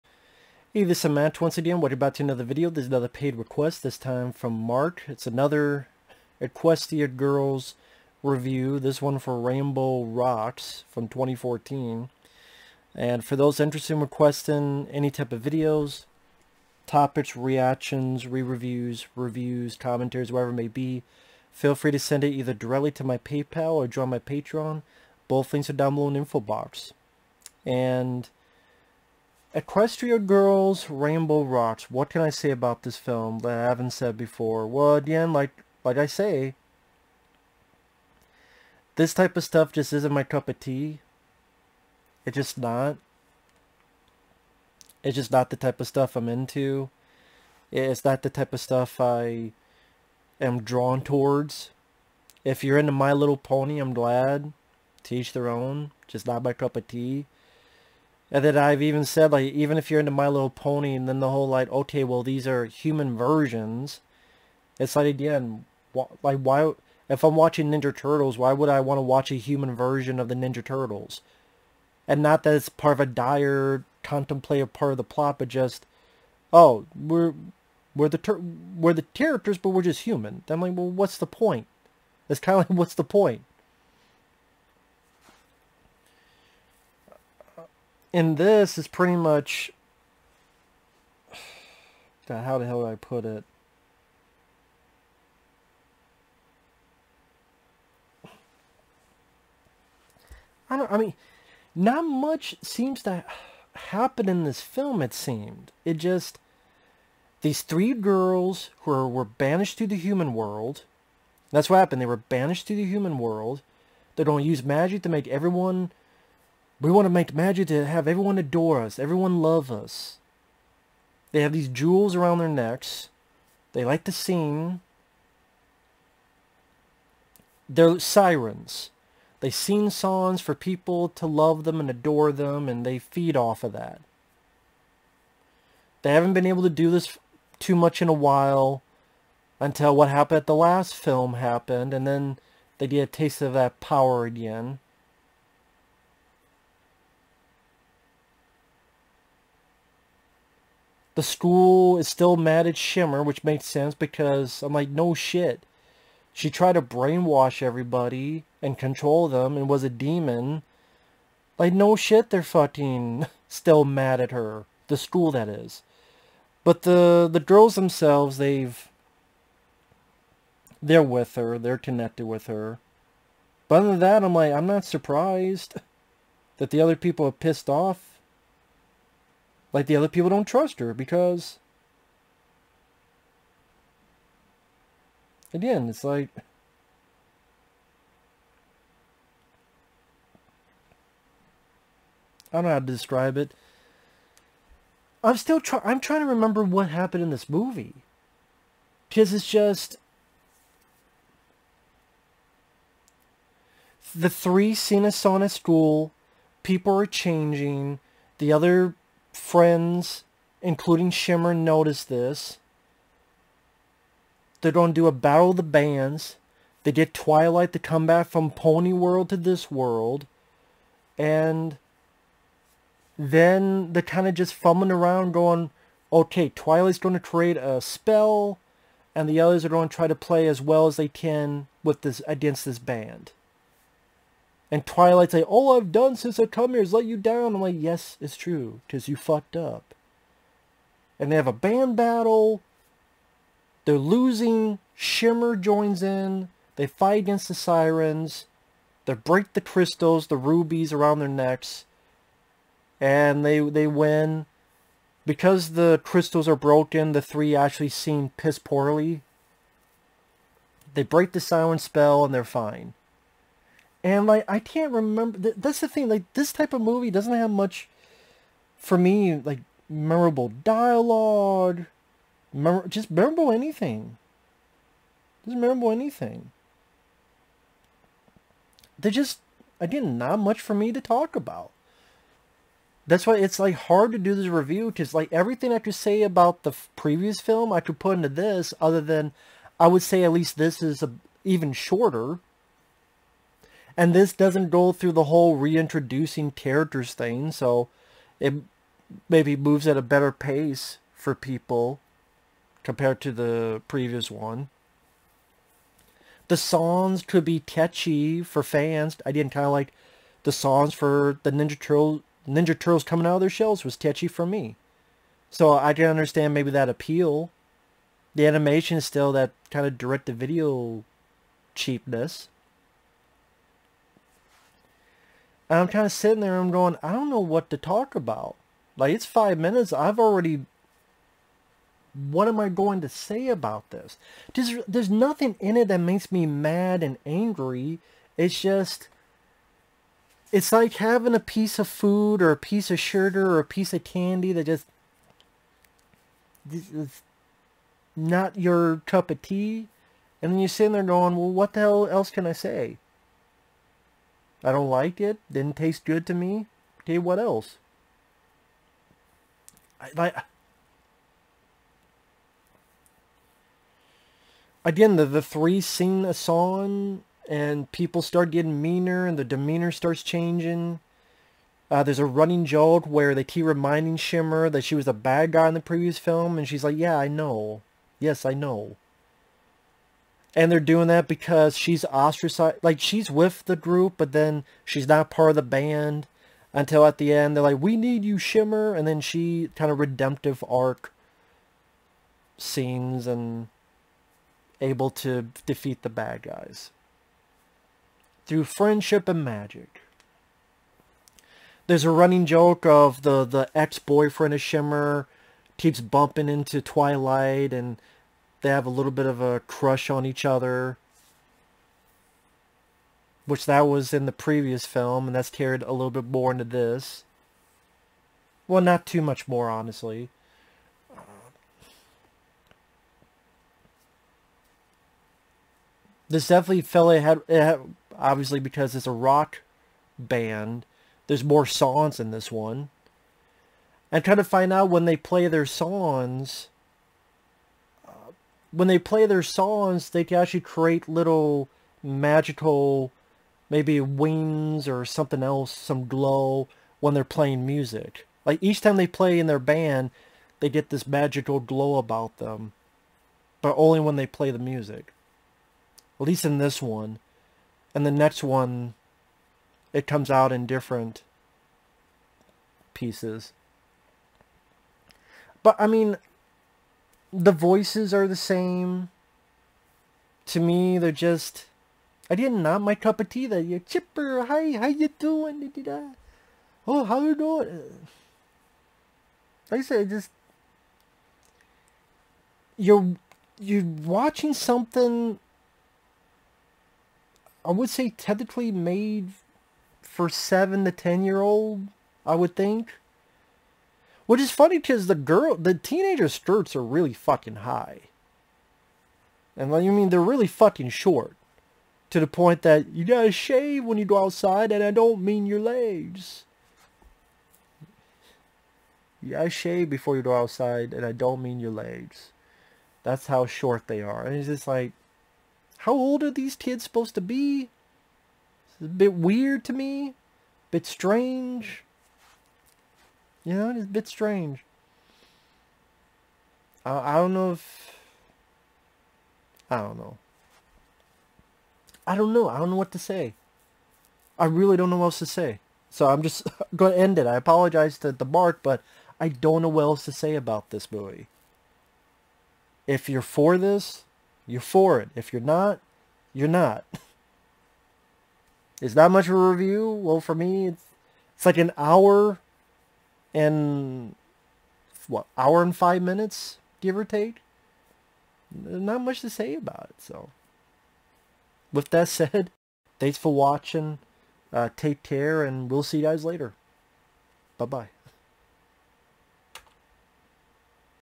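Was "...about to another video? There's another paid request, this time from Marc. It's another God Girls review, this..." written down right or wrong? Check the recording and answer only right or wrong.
wrong.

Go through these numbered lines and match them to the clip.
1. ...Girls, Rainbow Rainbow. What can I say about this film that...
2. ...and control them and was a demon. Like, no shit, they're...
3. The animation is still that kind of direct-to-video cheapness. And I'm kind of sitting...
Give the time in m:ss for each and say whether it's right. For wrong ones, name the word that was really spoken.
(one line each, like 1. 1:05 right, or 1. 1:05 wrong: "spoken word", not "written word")
1. 0:30 wrong: "Rocks", not "Rainbow"
2. 2:38 right
3. 5:18 right.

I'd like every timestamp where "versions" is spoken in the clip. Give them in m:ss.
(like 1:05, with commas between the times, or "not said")
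1:03, 1:09.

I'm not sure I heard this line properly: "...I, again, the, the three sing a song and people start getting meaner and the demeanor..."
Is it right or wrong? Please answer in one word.
right.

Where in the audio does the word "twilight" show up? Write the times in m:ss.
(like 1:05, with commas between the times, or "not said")
3:37, 3:46, 3:54, 6:46.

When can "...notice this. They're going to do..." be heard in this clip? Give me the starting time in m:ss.
3:31.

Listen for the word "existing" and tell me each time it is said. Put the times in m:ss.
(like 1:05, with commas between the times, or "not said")
not said.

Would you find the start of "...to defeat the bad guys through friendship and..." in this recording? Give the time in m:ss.
6:35.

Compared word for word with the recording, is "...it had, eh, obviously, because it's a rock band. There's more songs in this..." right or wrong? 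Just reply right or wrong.
right.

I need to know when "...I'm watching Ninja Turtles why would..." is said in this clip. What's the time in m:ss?
1:07.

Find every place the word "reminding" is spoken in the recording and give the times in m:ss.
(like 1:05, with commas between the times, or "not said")
6:13.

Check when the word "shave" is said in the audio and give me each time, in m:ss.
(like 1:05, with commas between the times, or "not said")
8:23, 8:29.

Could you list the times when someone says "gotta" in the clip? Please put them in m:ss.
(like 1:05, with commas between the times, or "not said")
8:23, 8:29.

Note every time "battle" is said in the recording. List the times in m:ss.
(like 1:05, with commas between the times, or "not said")
3:35, 4:01.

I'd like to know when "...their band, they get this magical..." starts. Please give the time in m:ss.
7:29.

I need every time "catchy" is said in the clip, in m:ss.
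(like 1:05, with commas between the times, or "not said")
5:07, 5:13.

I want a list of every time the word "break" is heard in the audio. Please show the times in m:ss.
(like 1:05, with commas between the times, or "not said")
4:09, 4:21.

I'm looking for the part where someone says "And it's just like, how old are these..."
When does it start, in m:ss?
8:34.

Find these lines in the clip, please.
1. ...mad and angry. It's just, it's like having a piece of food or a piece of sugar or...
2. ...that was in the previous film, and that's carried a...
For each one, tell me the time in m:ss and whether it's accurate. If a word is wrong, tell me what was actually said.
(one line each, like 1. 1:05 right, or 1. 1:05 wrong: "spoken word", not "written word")
1. 5:36 right
2. 6:53 right.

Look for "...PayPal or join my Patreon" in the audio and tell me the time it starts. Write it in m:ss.
0:23.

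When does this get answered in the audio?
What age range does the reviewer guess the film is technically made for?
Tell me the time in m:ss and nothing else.
8:10.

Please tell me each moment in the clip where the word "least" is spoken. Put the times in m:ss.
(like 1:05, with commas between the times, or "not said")
4:50, 7:36.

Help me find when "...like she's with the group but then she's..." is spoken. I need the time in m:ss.
6:22.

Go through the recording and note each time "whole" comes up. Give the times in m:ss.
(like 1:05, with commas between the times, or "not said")
1:01, 4:55.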